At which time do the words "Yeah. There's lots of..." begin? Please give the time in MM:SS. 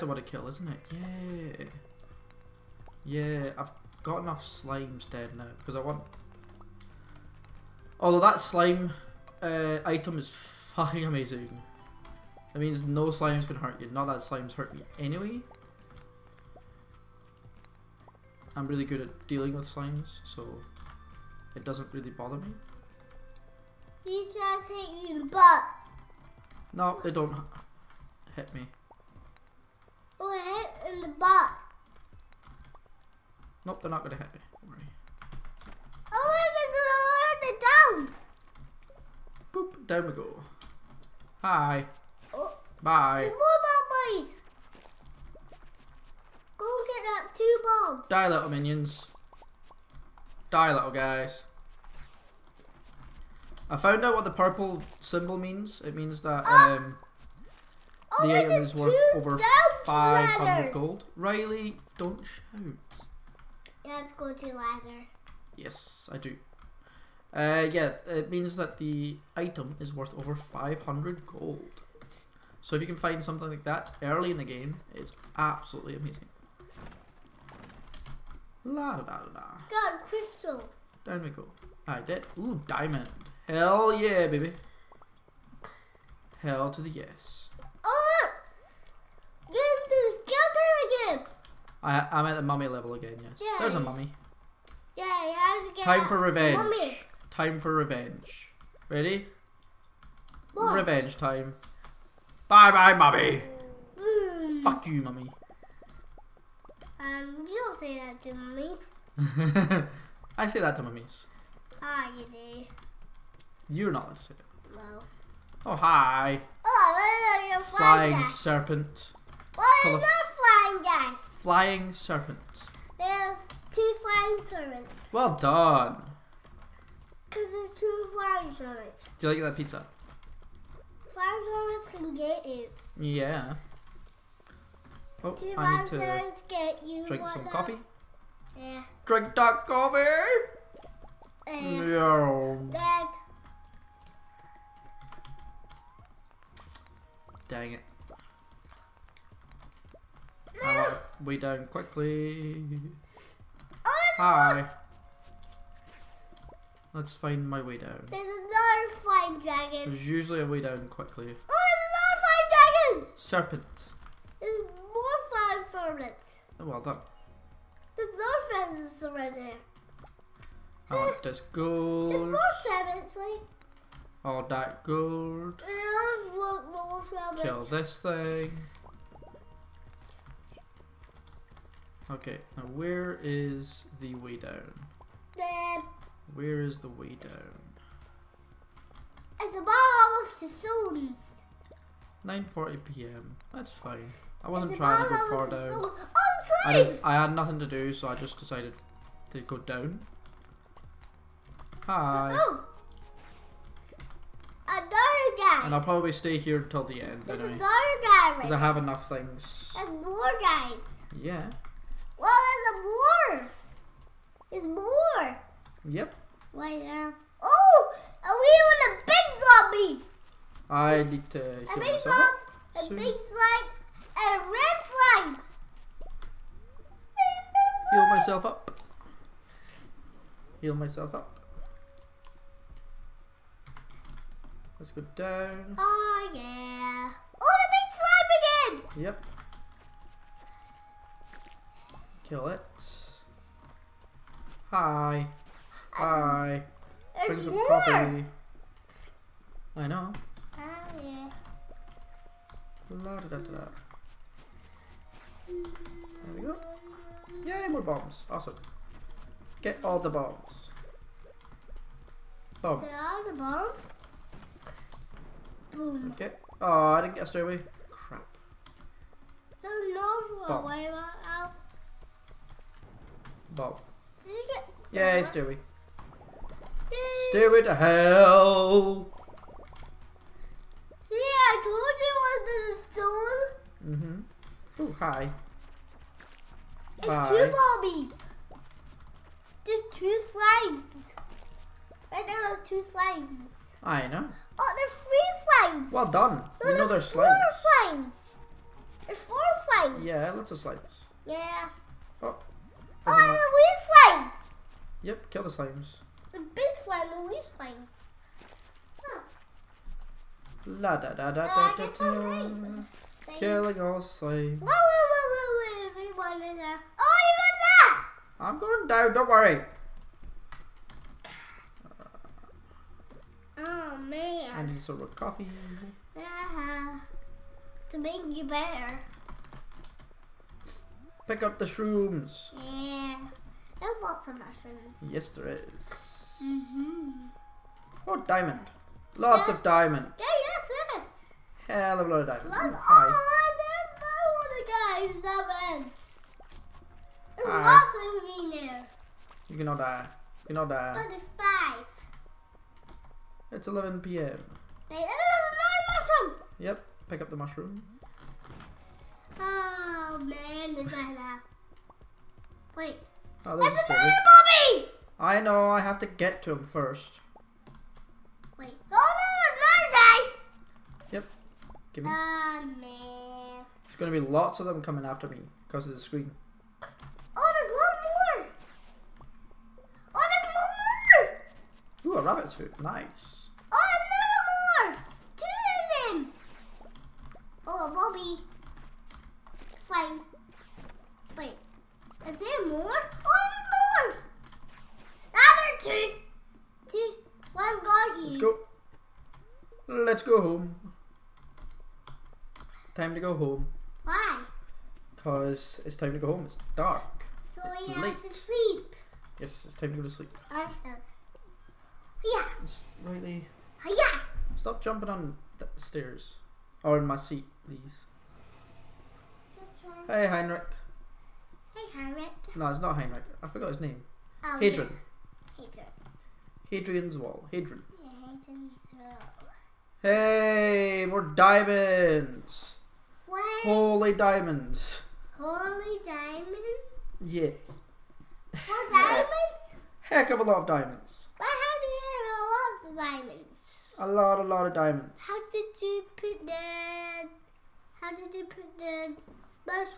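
05:32.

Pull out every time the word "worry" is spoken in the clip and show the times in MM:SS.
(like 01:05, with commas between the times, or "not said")
00:34, 05:19.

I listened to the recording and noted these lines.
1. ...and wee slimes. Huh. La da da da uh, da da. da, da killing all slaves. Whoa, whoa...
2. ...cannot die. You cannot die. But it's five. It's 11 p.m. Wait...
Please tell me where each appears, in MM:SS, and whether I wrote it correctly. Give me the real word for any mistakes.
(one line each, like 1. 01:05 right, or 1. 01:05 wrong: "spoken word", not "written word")
1. 05:07 right
2. 05:49 right.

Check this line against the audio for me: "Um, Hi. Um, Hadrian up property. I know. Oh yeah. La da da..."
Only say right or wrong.
wrong.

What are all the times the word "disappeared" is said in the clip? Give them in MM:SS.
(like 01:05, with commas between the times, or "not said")
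not said.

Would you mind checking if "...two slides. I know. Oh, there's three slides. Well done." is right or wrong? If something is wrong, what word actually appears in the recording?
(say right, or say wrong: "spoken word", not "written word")
right.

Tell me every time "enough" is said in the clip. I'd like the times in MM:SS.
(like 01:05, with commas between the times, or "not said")
00:04, 03:28.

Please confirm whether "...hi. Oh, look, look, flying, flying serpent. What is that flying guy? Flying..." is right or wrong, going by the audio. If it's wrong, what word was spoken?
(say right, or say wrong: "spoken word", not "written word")
right.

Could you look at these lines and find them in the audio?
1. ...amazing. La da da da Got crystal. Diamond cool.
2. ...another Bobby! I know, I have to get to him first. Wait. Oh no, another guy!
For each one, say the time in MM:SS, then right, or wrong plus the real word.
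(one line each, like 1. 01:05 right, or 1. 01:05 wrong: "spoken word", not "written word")
1. 01:15 right
2. 06:03 right.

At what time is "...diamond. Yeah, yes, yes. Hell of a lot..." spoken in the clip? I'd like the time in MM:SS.
05:39.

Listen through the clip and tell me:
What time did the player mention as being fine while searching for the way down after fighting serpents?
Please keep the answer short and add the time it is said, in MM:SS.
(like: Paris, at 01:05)
9.40pm, at 03:12.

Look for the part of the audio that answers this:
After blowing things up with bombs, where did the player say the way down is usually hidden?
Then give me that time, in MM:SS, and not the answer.
04:42.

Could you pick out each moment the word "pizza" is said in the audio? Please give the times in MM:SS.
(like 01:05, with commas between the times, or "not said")
02:09.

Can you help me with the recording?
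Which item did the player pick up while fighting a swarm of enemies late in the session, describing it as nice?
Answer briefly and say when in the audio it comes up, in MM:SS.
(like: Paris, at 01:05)
rabbit's foot, at 06:22.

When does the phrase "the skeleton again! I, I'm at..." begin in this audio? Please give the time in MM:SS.
01:29.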